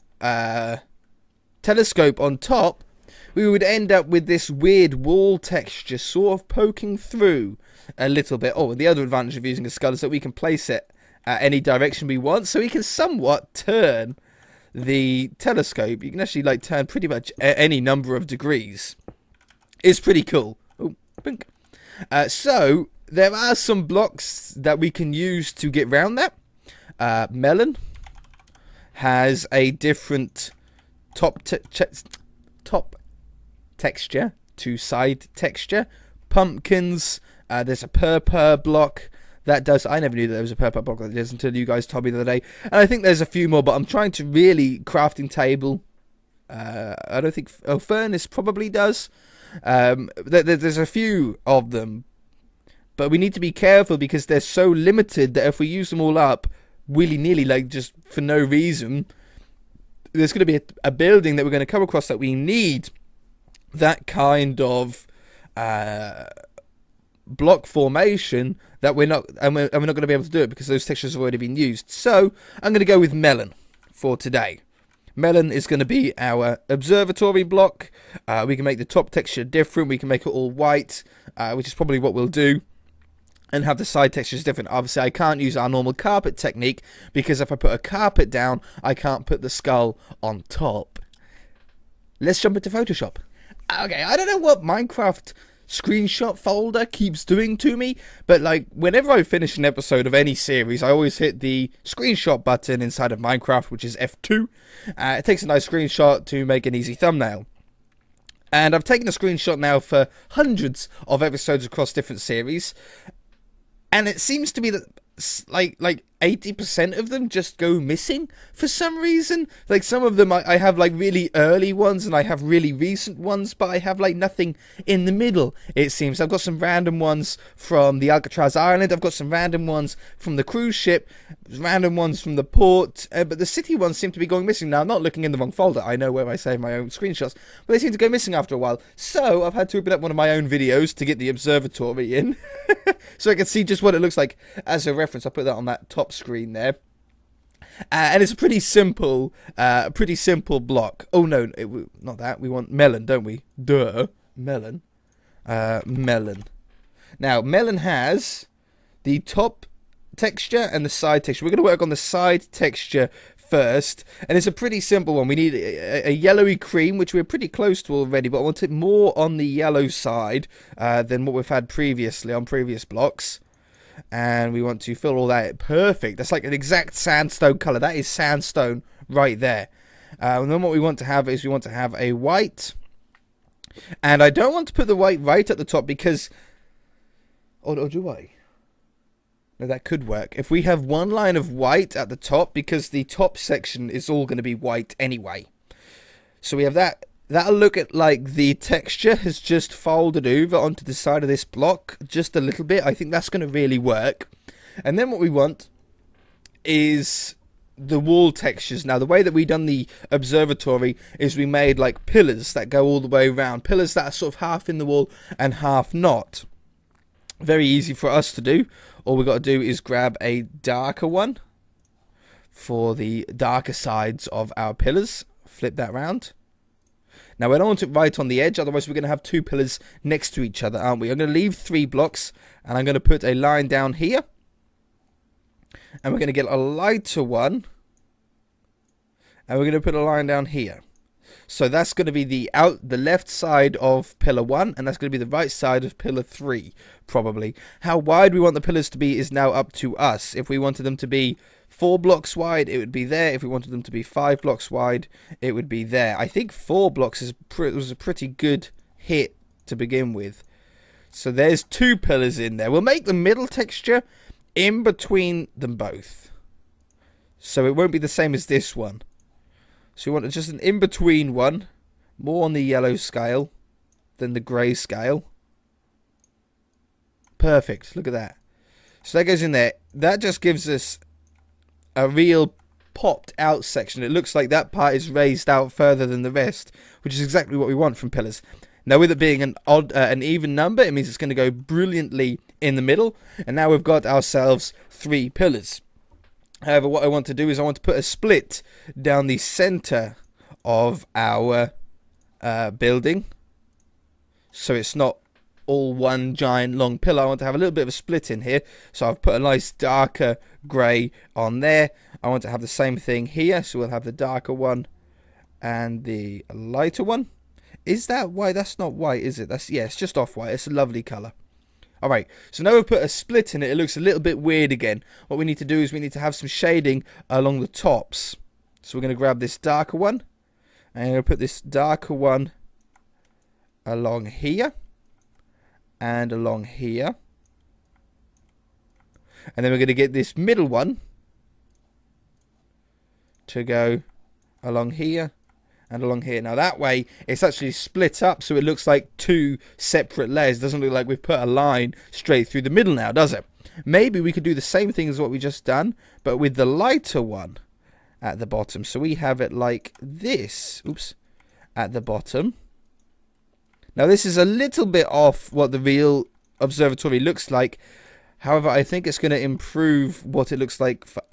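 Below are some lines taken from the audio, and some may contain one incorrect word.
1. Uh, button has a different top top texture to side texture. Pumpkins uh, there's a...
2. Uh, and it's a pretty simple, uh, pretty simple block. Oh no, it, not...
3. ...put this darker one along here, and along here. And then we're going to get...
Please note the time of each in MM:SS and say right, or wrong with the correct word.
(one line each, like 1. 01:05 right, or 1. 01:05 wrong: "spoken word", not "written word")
1. 00:26 wrong: "melon", not "button"
2. 02:27 right
3. 05:31 right.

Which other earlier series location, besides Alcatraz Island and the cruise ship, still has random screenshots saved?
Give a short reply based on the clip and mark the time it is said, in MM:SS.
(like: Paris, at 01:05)
The port, at 02:12.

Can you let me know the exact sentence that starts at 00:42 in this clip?
And I think there's a few more, but I'm trying to really crafting table.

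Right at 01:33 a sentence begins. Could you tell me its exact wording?
Okay, I don't know what Minecraft screenshot folder keeps doing to me.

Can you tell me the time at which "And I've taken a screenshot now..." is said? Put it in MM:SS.
01:48.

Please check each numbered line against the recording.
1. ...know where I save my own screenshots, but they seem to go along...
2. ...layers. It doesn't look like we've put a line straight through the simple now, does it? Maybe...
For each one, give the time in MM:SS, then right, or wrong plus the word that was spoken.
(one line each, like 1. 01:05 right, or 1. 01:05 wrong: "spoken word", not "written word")
1. 02:15 wrong: "missing", not "along"
2. 05:50 wrong: "middle", not "simple".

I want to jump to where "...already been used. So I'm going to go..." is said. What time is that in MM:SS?
01:11.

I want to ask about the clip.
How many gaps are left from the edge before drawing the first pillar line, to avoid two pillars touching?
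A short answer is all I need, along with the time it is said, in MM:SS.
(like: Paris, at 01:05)
3, at 03:51.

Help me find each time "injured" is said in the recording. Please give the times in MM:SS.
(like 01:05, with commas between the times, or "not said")
not said.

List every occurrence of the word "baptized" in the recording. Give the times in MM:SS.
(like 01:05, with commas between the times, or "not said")
not said.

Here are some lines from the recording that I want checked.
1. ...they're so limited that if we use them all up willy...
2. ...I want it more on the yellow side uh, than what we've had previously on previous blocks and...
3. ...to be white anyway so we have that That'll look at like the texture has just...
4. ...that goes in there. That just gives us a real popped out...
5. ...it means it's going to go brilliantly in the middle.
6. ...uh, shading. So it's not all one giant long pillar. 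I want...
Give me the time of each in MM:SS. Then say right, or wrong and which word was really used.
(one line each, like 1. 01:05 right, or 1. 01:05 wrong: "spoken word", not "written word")
1. 00:54 right
2. 02:48 right
3. 03:14 right
4. 04:39 right
5. 04:50 right
6. 05:02 wrong: "building", not "shading".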